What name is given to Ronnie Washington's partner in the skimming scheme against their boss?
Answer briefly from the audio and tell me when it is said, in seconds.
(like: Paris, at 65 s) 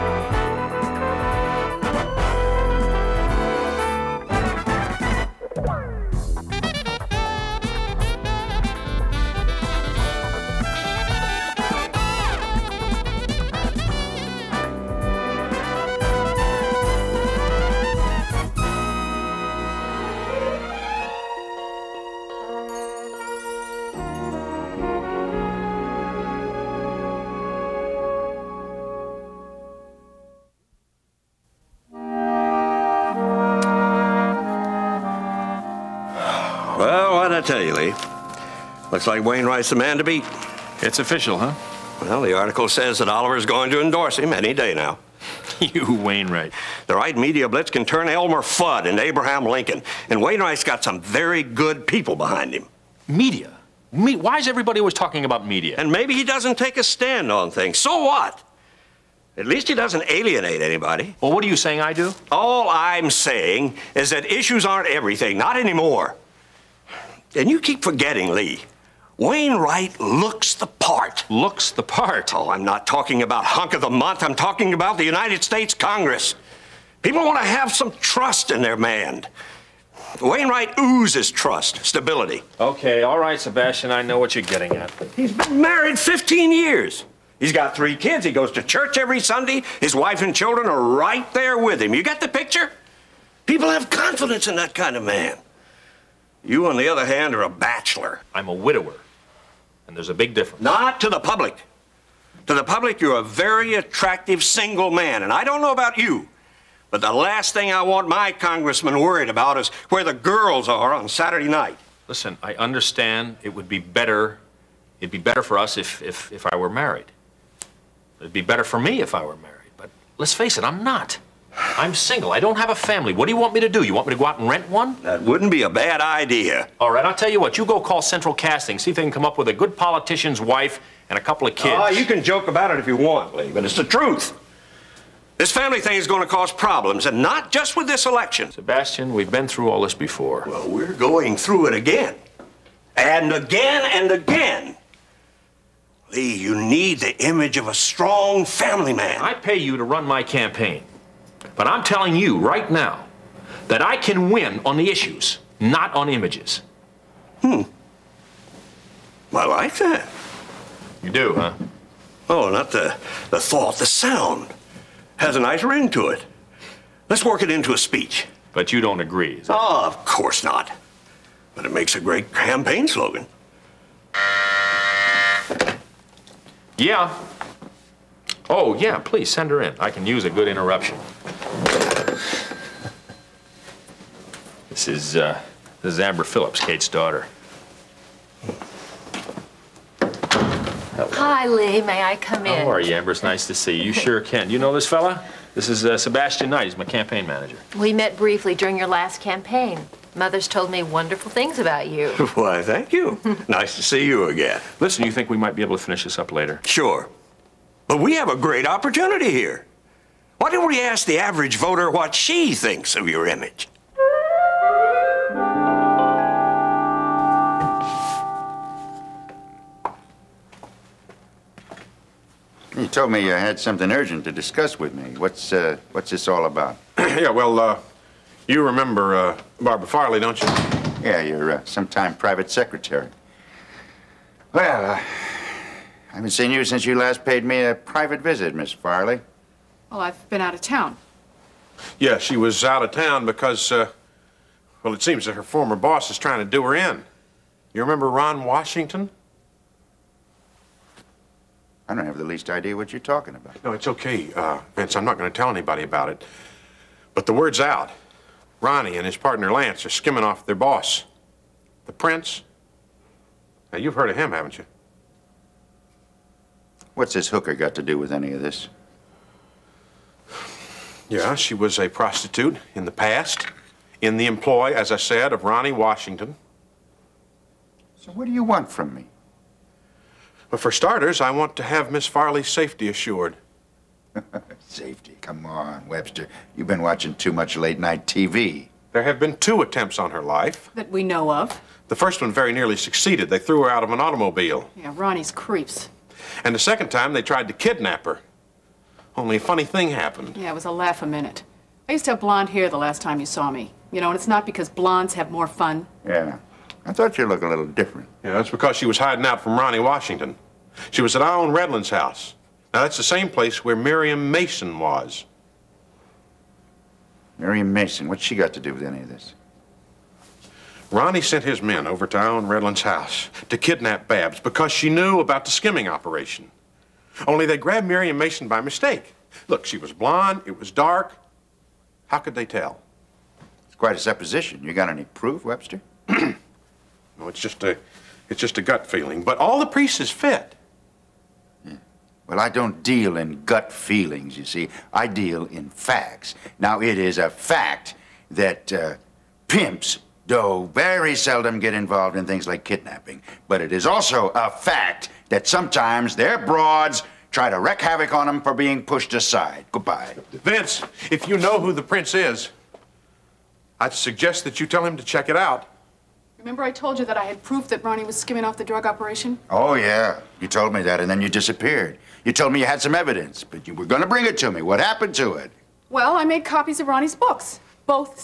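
Lance, at 259 s.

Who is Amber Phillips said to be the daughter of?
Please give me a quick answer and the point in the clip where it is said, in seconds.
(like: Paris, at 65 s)
Kate, at 186 s.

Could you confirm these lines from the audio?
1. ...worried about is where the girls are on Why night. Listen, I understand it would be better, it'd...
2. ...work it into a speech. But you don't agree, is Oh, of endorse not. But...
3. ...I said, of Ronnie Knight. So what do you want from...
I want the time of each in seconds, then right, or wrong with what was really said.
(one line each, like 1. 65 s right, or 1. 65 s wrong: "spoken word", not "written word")
1. 108 s wrong: "Saturday", not "Why"
2. 167 s wrong: "course", not "endorse"
3. 274 s wrong: "Washington", not "Knight".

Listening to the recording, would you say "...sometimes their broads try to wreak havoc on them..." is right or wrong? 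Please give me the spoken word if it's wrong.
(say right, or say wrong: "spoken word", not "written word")
right.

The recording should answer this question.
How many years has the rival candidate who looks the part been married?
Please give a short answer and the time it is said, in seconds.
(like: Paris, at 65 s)
15, at 85 s.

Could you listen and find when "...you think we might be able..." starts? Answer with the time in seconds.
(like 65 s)
205 s.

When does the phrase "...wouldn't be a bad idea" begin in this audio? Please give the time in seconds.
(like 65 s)
125 s.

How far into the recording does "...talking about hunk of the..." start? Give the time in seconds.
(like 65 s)
72 s.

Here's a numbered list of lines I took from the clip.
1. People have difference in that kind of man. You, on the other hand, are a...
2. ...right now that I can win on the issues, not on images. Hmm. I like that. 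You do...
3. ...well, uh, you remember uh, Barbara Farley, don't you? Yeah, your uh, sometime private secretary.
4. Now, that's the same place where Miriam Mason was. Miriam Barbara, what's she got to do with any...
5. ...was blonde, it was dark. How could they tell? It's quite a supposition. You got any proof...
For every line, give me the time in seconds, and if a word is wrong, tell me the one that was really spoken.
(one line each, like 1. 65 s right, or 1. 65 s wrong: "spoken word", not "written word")
1. 93 s wrong: "confidence", not "difference"
2. 152 s right
3. 227 s right
4. 312 s wrong: "Mason", not "Barbara"
5. 329 s right.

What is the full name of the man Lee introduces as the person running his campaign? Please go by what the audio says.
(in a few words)
Sebastian Knight.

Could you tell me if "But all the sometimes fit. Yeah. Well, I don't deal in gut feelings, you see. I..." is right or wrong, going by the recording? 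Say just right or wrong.
wrong.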